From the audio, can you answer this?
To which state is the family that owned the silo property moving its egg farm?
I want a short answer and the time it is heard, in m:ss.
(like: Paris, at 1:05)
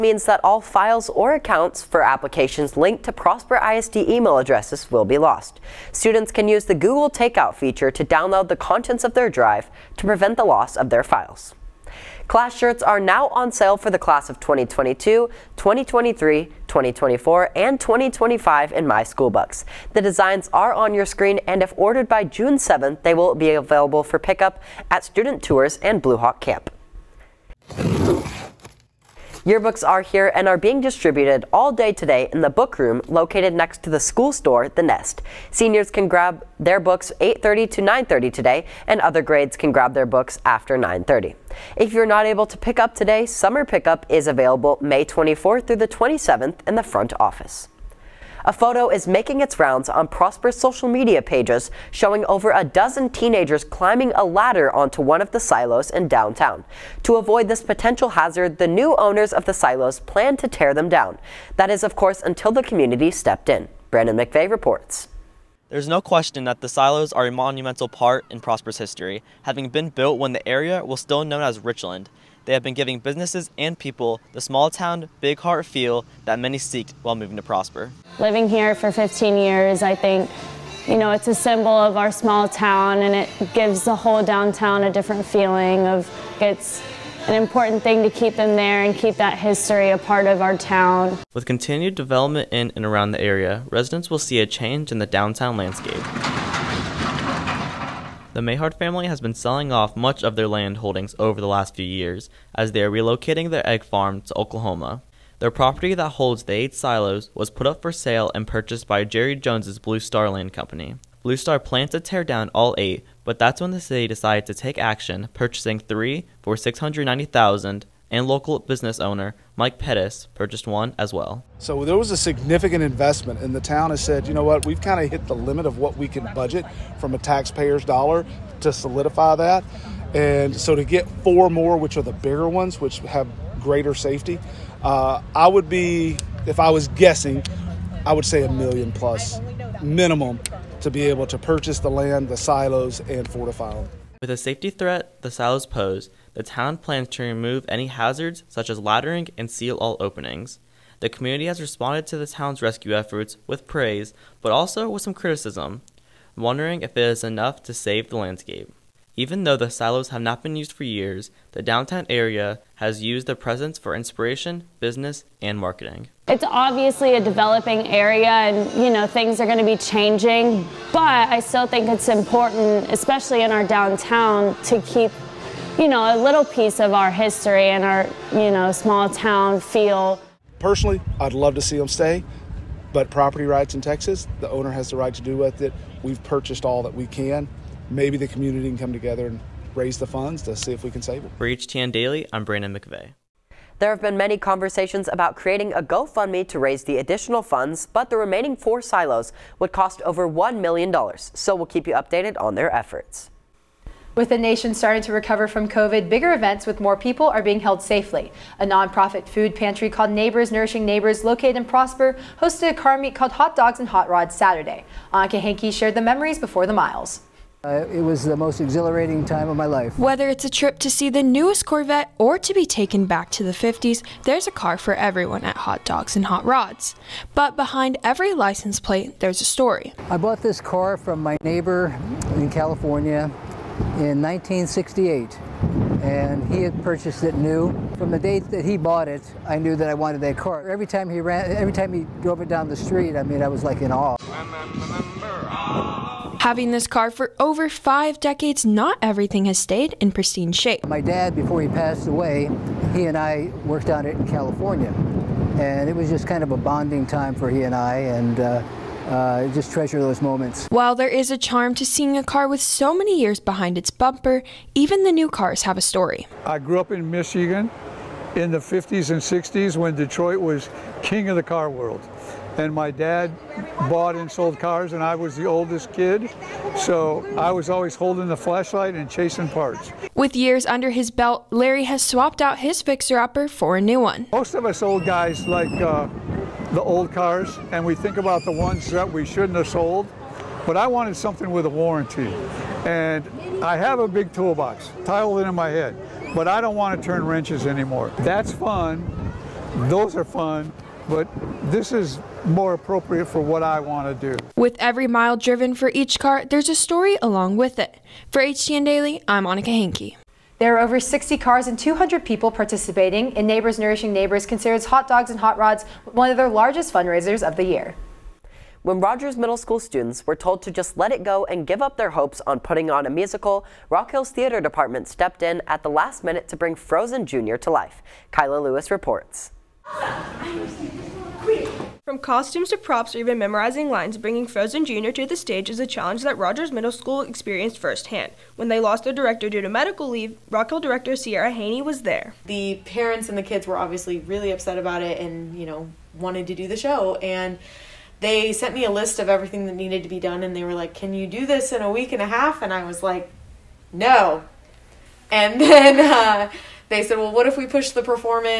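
Oklahoma, at 1:44.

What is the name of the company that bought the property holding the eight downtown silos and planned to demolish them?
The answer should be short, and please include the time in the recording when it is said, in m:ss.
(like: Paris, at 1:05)
Blue Star Land Company, at 1:49.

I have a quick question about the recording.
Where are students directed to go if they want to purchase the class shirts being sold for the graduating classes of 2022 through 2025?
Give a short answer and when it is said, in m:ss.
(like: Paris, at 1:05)
My School, at 0:18.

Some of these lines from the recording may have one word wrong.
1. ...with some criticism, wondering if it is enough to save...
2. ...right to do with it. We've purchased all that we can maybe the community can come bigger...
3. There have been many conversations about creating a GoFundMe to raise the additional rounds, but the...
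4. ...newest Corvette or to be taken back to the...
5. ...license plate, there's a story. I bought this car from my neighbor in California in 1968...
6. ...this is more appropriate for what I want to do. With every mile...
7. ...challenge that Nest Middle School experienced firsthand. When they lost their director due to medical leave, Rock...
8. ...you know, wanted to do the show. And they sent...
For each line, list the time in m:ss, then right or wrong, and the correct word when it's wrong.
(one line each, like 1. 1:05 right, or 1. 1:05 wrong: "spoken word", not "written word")
1. 2:34 right
2. 3:04 wrong: "together", not "bigger"
3. 3:13 wrong: "funds", not "rounds"
4. 3:41 right
5. 3:48 right
6. 5:01 right
7. 5:35 wrong: "Rogers", not "Nest"
8. 5:45 right.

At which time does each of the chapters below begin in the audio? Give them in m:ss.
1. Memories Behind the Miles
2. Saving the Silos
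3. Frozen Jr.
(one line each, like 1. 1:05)
1. 3:23
2. 0:47
3. 5:18.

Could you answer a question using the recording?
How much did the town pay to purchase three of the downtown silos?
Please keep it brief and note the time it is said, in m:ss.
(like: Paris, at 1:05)
690,000, at 1:56.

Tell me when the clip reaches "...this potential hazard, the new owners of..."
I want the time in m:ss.
0:57.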